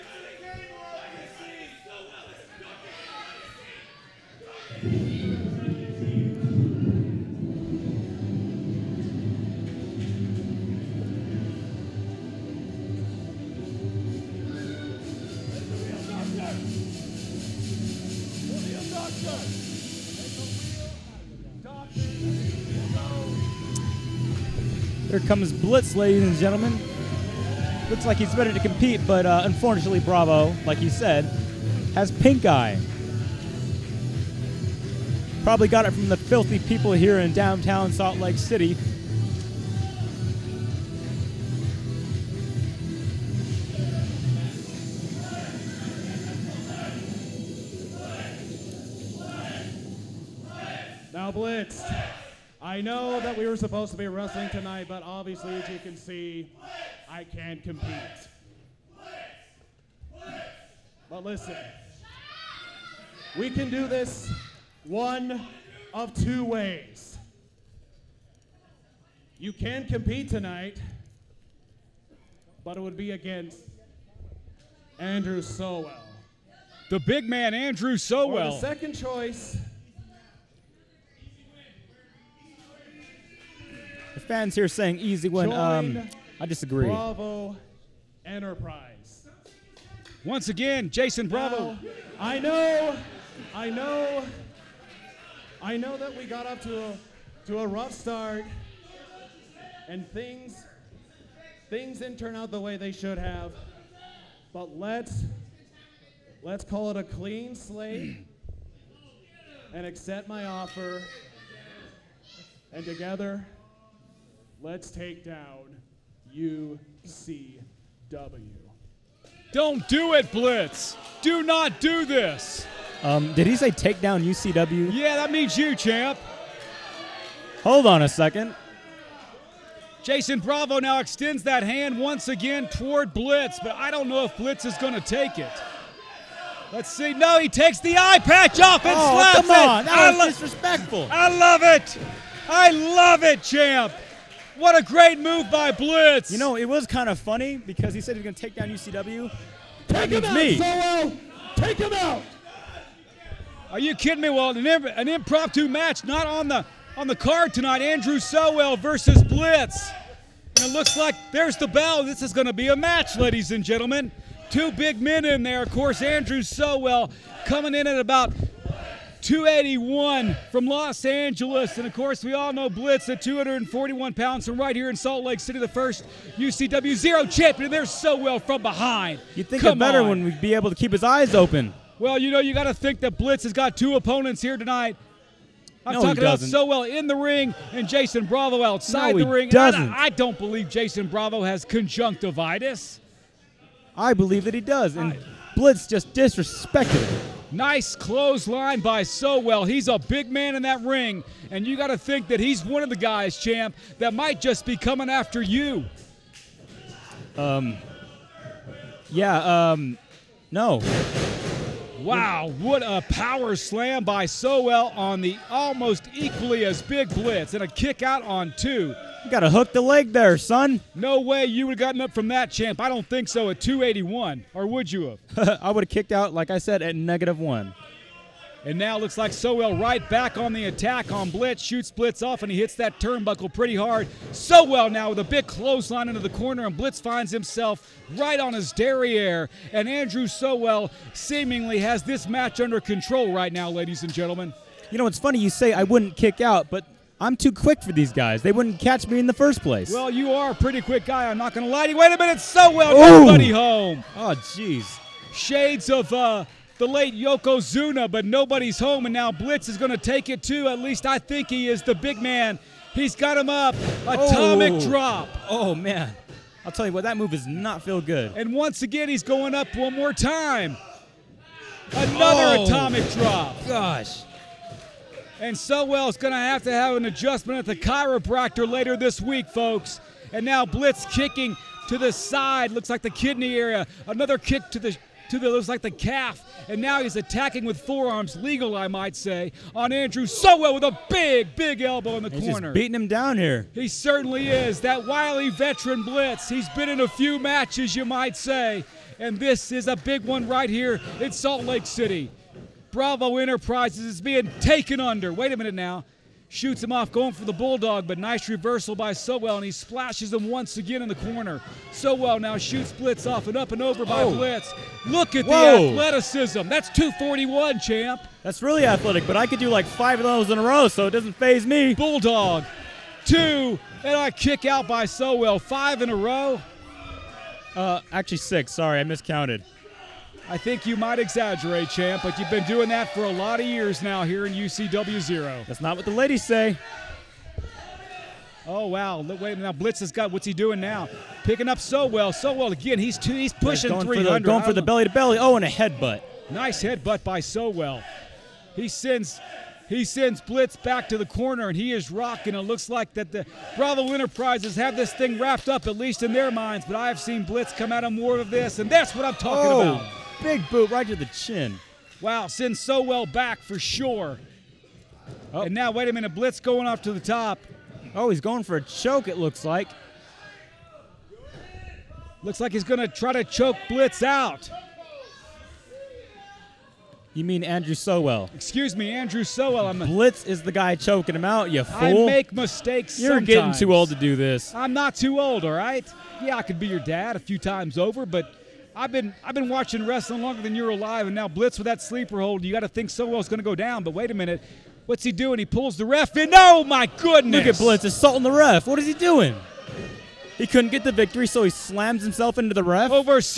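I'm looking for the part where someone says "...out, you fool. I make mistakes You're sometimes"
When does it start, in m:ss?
6:21.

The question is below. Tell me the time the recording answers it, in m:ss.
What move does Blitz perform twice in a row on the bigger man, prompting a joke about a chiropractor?
4:32.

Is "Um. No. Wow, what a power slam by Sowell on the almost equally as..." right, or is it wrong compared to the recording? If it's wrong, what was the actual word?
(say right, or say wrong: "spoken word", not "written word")
right.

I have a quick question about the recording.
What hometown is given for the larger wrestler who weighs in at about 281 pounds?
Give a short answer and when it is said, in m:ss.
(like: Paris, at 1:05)
Los Angeles, at 2:50.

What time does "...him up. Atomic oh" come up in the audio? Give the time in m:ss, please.
4:23.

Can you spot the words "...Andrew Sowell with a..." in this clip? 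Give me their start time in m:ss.
4:49.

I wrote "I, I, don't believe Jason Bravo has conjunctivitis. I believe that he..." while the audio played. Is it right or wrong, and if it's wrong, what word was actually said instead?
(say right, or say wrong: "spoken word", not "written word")
right.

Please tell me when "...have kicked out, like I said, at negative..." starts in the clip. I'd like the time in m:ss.
3:45.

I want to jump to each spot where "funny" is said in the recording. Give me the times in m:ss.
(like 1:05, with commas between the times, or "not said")
2:27, 4:05.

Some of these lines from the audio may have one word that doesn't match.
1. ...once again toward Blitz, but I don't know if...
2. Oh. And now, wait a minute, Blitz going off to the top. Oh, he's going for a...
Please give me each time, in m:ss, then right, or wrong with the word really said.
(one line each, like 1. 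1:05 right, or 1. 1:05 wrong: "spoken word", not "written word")
1. 2:11 right
2. 6:05 right.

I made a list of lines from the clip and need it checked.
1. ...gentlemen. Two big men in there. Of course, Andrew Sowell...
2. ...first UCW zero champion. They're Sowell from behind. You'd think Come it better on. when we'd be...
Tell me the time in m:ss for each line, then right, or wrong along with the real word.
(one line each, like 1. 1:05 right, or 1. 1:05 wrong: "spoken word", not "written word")
1. 2:43 right
2. 2:55 right.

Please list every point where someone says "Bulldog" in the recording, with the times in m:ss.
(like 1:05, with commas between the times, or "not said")
5:07, 5:21.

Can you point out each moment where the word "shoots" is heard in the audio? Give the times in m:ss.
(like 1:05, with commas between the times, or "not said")
3:51, 5:06, 5:12.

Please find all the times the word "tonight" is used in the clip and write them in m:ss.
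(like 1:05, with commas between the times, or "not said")
0:54, 1:10, 2:37, 3:04.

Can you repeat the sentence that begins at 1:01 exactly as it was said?
But listen, we can do this one of two ways.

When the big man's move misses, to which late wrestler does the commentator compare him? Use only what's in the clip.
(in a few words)
Yokozuna.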